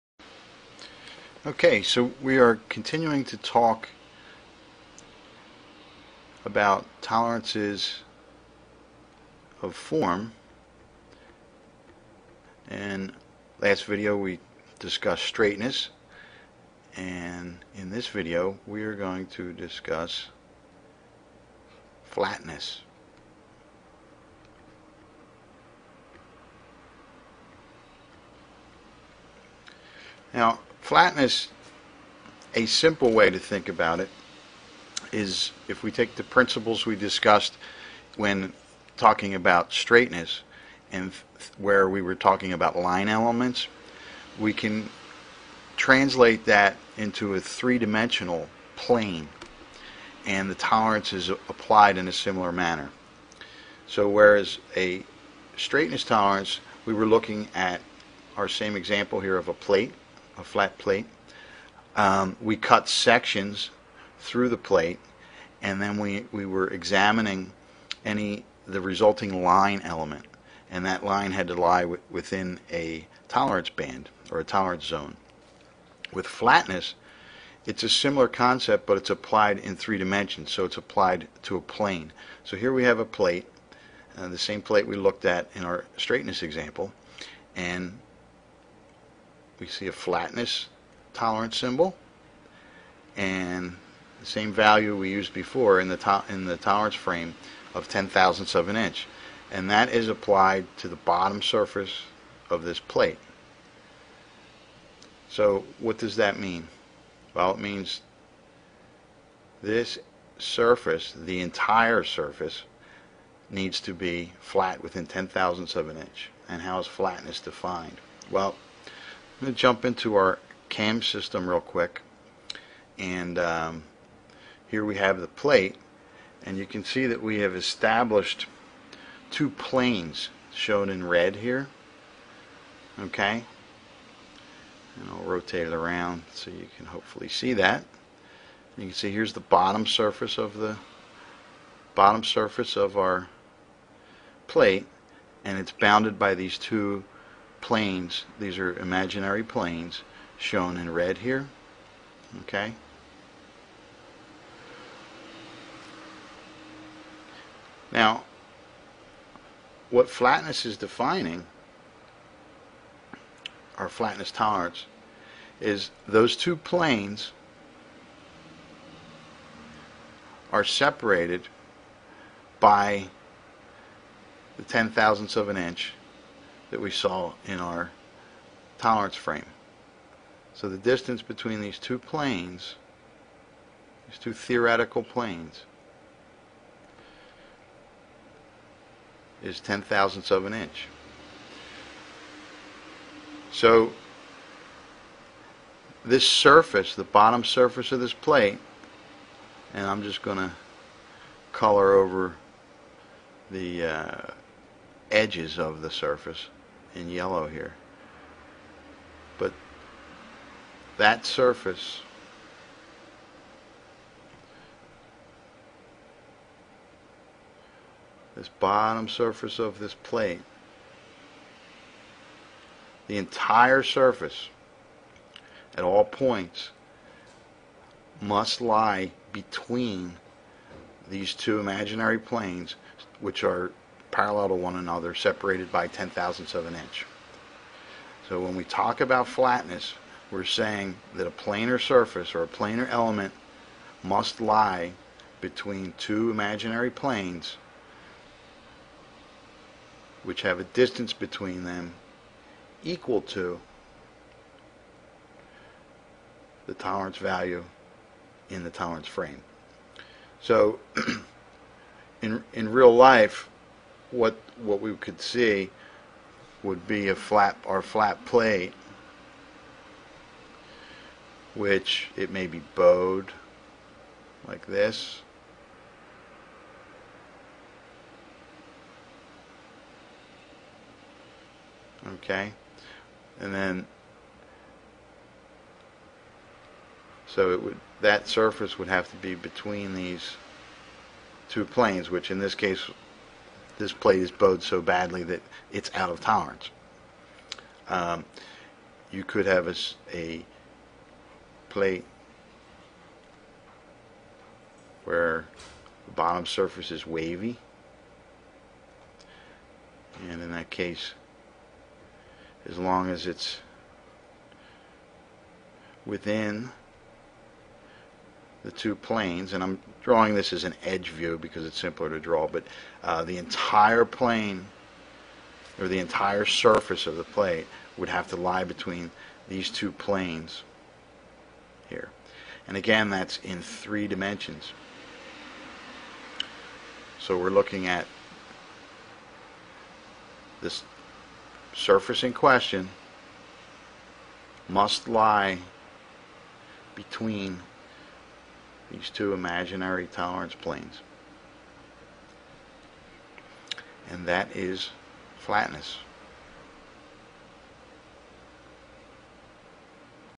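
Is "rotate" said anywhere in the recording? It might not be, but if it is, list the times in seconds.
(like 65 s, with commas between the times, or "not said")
135 s.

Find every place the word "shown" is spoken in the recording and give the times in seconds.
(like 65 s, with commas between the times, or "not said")
130 s, 150 s.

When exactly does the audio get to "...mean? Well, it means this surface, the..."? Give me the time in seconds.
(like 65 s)
106 s.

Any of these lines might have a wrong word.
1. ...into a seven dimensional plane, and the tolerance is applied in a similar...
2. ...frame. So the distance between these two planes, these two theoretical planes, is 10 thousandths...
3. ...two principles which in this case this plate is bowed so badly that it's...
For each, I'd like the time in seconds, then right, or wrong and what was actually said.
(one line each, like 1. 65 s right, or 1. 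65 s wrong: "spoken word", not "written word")
1. 46 s wrong: "three", not "seven"
2. 179 s right
3. 291 s wrong: "planes", not "principles".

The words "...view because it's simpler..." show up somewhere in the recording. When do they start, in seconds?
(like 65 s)
321 s.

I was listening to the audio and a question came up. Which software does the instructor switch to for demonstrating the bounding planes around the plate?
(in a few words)
CAM system.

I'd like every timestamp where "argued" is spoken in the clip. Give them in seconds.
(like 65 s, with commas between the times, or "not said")
not said.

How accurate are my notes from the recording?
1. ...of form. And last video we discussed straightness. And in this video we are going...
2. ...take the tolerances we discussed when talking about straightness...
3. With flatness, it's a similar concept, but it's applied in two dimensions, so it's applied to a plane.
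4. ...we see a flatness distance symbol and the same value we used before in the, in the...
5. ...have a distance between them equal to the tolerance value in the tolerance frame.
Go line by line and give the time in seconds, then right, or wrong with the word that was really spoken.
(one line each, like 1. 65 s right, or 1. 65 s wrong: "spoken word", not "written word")
1. 9 s right
2. 35 s wrong: "principles", not "tolerances"
3. 76 s wrong: "three", not "two"
4. 89 s wrong: "tolerance", not "distance"
5. 250 s right.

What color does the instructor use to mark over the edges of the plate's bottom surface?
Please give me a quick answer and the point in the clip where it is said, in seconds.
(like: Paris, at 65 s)
Yellow, at 207 s.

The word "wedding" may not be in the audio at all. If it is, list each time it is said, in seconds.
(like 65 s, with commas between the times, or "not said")
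not said.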